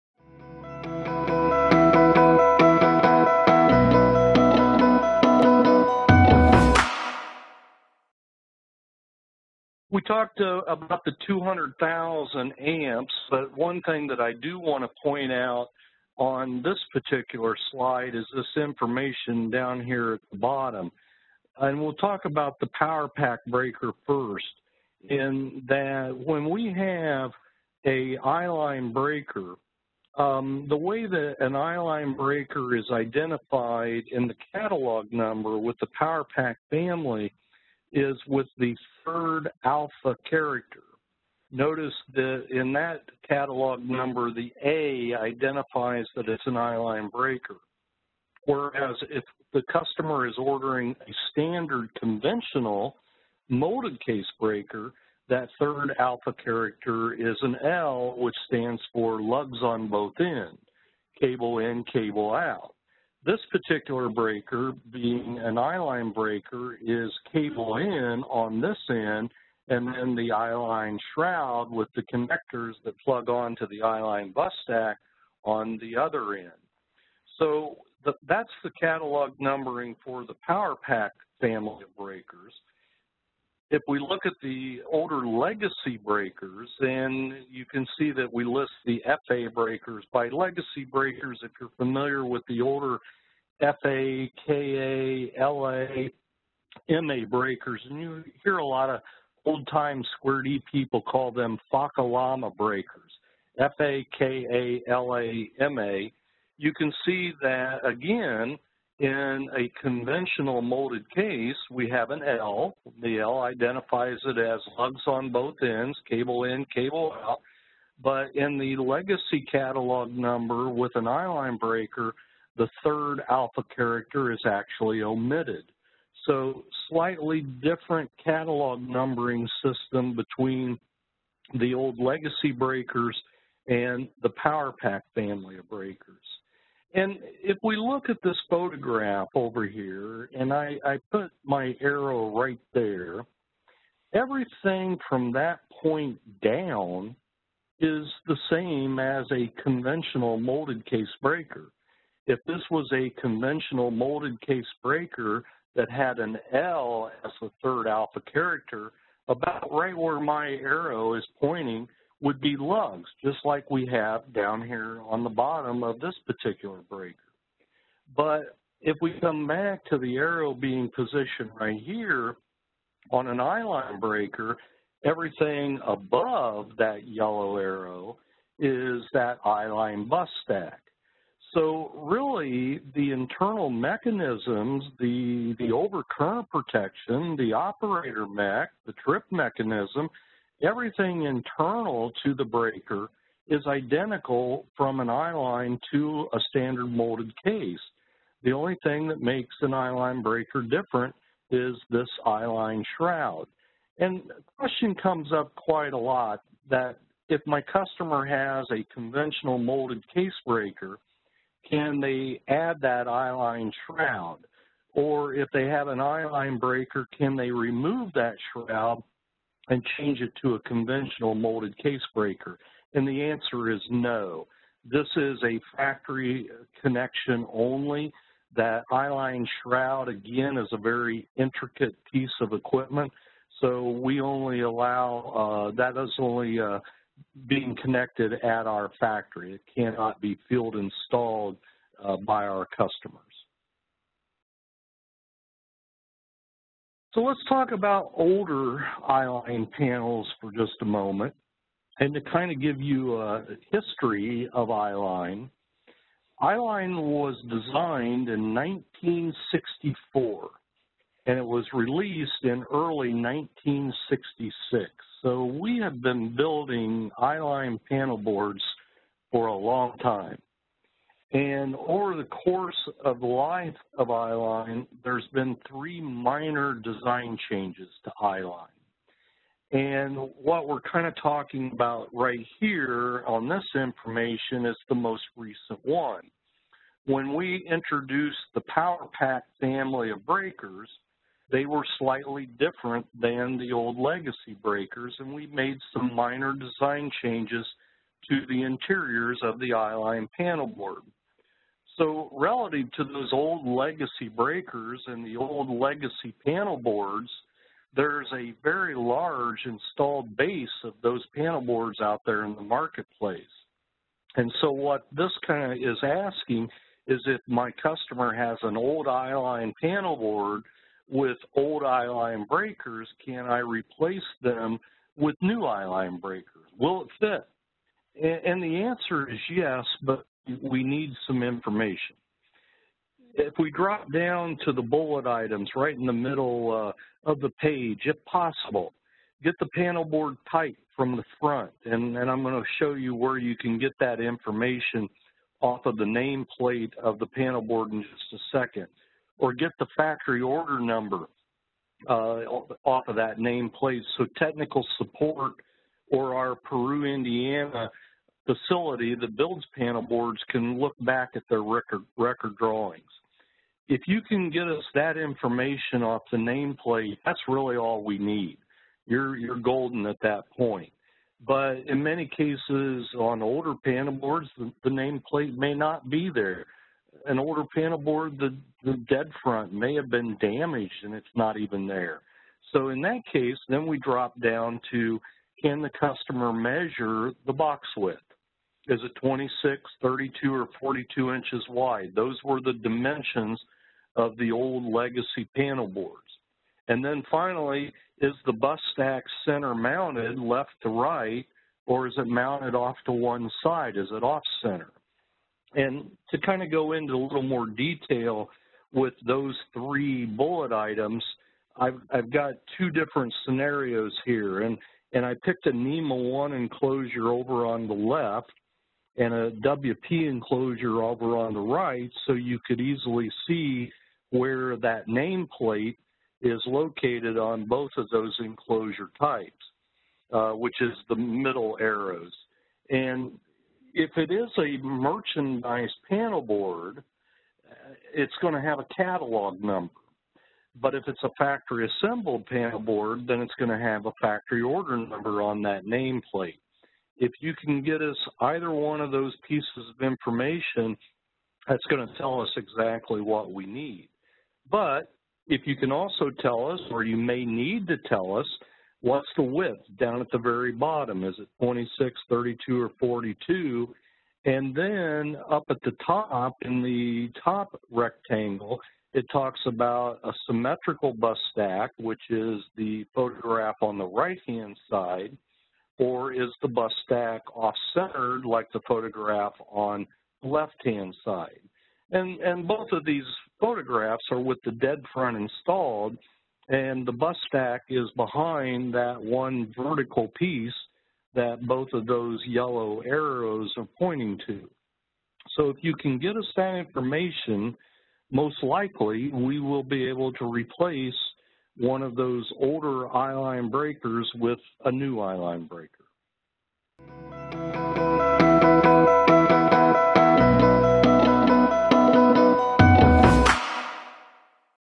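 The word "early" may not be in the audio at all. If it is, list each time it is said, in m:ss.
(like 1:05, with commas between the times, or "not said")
4:22.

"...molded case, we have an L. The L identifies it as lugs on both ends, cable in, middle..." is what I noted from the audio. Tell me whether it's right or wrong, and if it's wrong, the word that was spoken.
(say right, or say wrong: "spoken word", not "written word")
wrong: "cable", not "middle".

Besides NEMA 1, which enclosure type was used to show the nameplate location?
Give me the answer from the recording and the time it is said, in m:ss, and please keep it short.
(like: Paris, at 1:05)
WP, at 6:59.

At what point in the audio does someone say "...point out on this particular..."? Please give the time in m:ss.
0:15.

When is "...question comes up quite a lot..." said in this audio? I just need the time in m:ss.
3:24.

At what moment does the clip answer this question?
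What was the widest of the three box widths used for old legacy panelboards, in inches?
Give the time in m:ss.
6:30.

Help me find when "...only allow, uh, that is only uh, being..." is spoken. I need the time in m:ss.
3:54.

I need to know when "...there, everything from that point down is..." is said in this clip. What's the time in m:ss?
2:22.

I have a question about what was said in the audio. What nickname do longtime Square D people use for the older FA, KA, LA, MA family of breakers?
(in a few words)
Fakalama breakers.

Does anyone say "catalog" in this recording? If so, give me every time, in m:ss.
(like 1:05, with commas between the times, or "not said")
0:34, 0:43, 1:18, 1:59, 2:08, 7:18.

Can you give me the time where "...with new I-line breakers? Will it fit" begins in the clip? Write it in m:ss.
5:25.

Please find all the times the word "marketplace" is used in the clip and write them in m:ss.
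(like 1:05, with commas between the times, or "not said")
5:12.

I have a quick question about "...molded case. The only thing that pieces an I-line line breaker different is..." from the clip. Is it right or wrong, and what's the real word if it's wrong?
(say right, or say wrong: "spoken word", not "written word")
wrong: "makes", not "pieces".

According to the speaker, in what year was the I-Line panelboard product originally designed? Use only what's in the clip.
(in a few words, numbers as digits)
1964.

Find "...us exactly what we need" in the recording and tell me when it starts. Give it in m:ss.
7:32.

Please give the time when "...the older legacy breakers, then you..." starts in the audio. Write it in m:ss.
1:24.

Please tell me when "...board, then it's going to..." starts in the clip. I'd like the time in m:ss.
7:22.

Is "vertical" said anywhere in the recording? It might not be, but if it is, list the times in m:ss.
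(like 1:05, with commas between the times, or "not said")
8:09.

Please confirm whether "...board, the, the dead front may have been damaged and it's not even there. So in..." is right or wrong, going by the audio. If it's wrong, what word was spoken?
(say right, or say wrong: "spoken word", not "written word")
right.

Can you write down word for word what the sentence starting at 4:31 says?
And over the course of the life of I-line, there's been three minor design changes to I-line.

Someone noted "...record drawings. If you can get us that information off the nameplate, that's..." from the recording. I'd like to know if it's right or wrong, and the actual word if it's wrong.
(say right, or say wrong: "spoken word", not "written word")
right.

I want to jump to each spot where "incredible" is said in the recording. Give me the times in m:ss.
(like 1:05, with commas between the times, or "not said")
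not said.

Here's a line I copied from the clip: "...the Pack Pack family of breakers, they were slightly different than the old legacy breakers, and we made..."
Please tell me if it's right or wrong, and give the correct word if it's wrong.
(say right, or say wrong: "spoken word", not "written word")
wrong: "Power", not "Pack".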